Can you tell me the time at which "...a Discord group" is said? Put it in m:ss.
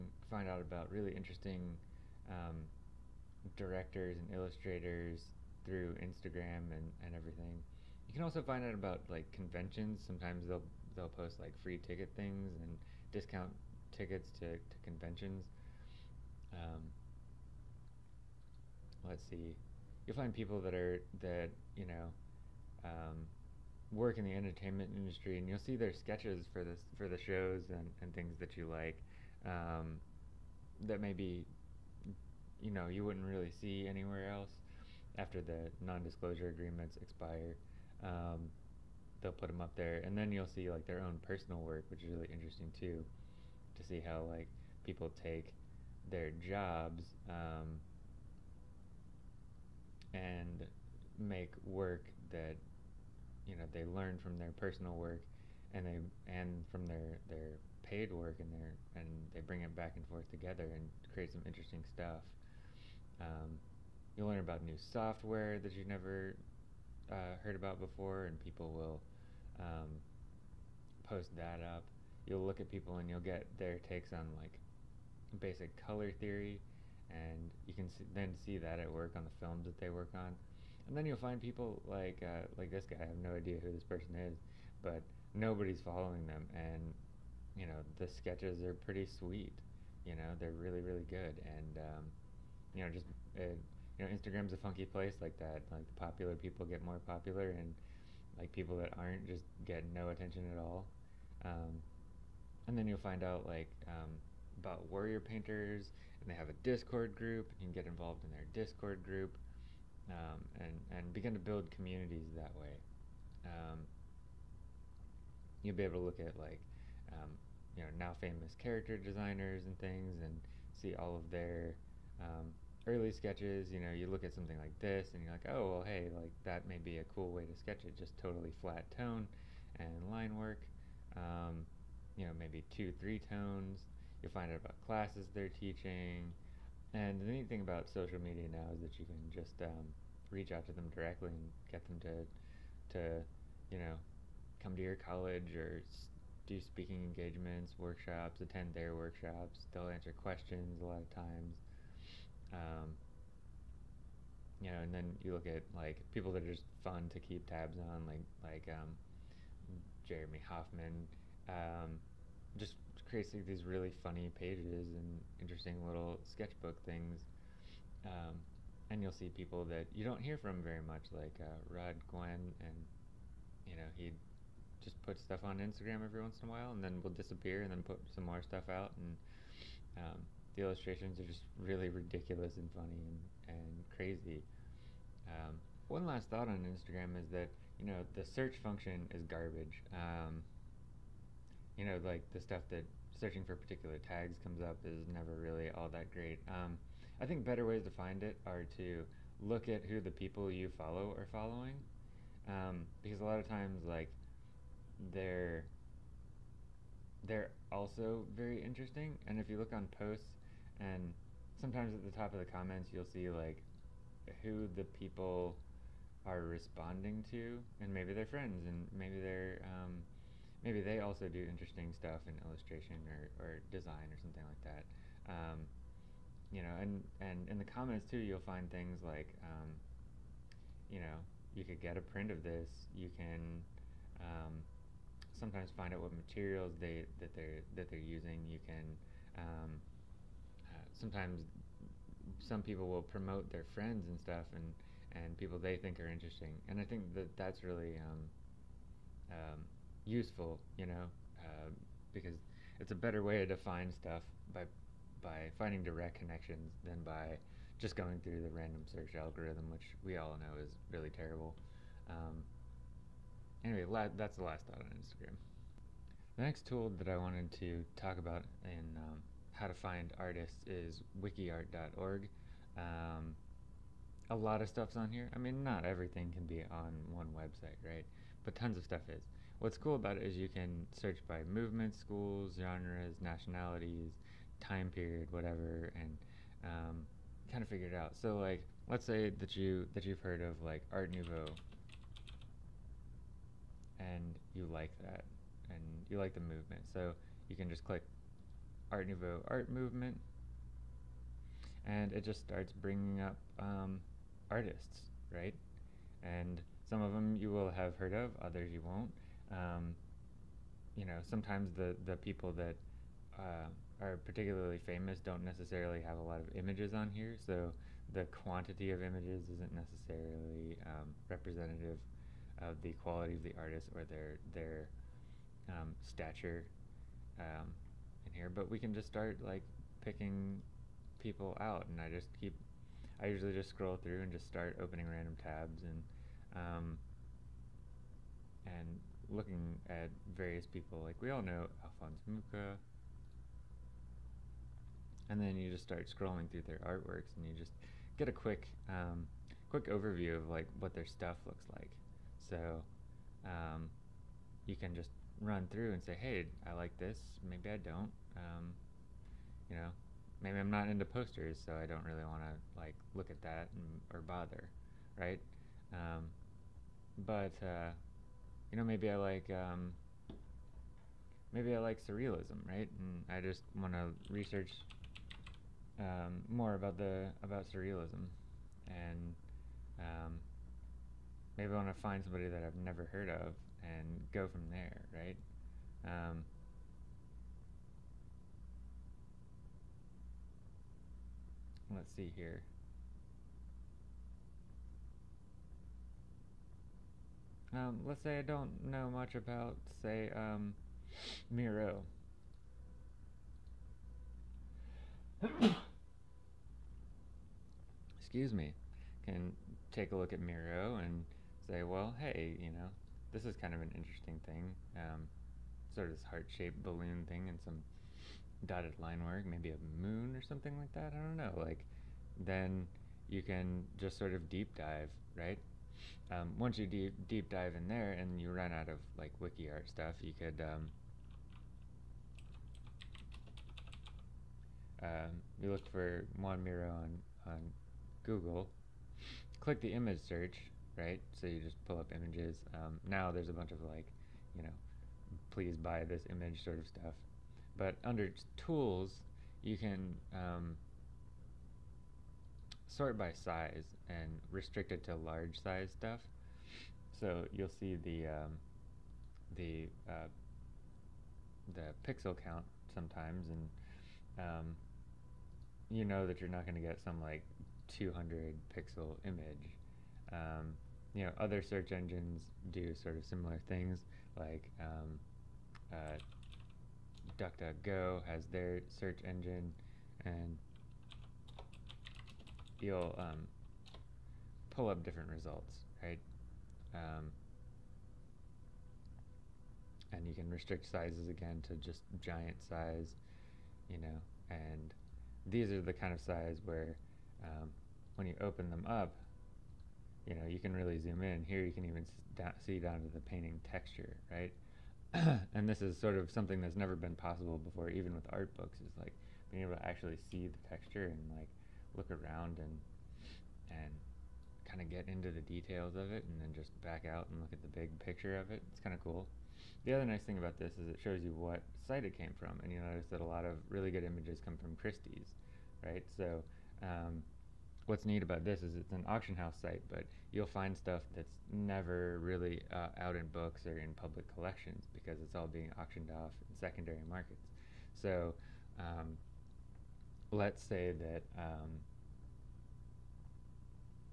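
1:46.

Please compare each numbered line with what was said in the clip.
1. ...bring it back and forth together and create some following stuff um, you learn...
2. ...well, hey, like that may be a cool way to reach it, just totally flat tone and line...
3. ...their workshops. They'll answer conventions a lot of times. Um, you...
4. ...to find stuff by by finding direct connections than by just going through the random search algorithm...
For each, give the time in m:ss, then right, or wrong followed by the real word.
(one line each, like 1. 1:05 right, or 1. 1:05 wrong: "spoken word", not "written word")
1. 0:59 wrong: "interesting", not "following"
2. 2:05 wrong: "sketch", not "reach"
3. 2:28 wrong: "questions", not "conventions"
4. 4:13 right.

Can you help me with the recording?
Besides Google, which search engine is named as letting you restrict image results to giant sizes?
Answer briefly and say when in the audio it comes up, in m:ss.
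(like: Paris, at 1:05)
DuckDuckGo, at 7:57.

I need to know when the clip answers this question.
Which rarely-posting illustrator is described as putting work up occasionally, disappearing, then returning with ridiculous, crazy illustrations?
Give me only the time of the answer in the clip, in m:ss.
2:51.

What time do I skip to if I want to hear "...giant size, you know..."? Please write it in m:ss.
8:12.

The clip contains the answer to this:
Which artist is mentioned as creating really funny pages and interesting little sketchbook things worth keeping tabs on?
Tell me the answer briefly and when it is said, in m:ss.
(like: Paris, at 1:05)
Jeremy Hoffman, at 2:40.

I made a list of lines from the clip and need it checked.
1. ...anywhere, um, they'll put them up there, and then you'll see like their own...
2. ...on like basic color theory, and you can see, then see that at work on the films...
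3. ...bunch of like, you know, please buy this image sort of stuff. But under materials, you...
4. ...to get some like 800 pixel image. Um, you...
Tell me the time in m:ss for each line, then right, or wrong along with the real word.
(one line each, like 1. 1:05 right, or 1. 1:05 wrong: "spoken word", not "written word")
1. 0:36 wrong: "expire", not "anywhere"
2. 1:14 right
3. 7:23 wrong: "tools", not "materials"
4. 7:46 wrong: "200", not "800".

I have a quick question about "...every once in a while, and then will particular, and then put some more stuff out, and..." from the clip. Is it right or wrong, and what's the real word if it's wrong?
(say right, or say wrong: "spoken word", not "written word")
wrong: "disappear", not "particular".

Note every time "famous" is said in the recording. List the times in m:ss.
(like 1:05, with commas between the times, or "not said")
1:58, 5:14.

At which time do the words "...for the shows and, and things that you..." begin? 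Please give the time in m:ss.
0:26.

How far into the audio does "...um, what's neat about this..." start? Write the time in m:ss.
8:46.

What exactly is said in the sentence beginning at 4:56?
So you can just click Art Nouveau art movement, and it just starts bringing up um, artists, right?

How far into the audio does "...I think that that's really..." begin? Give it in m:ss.
4:06.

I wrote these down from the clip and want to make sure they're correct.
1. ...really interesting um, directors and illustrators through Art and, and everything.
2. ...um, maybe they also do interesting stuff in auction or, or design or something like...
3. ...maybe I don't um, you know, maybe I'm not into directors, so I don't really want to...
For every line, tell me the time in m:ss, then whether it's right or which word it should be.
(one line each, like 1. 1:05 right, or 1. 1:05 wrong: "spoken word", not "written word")
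1. 0:00 wrong: "Instagram", not "Art"
2. 3:39 wrong: "illustration", not "auction"
3. 5:57 wrong: "posters", not "directors".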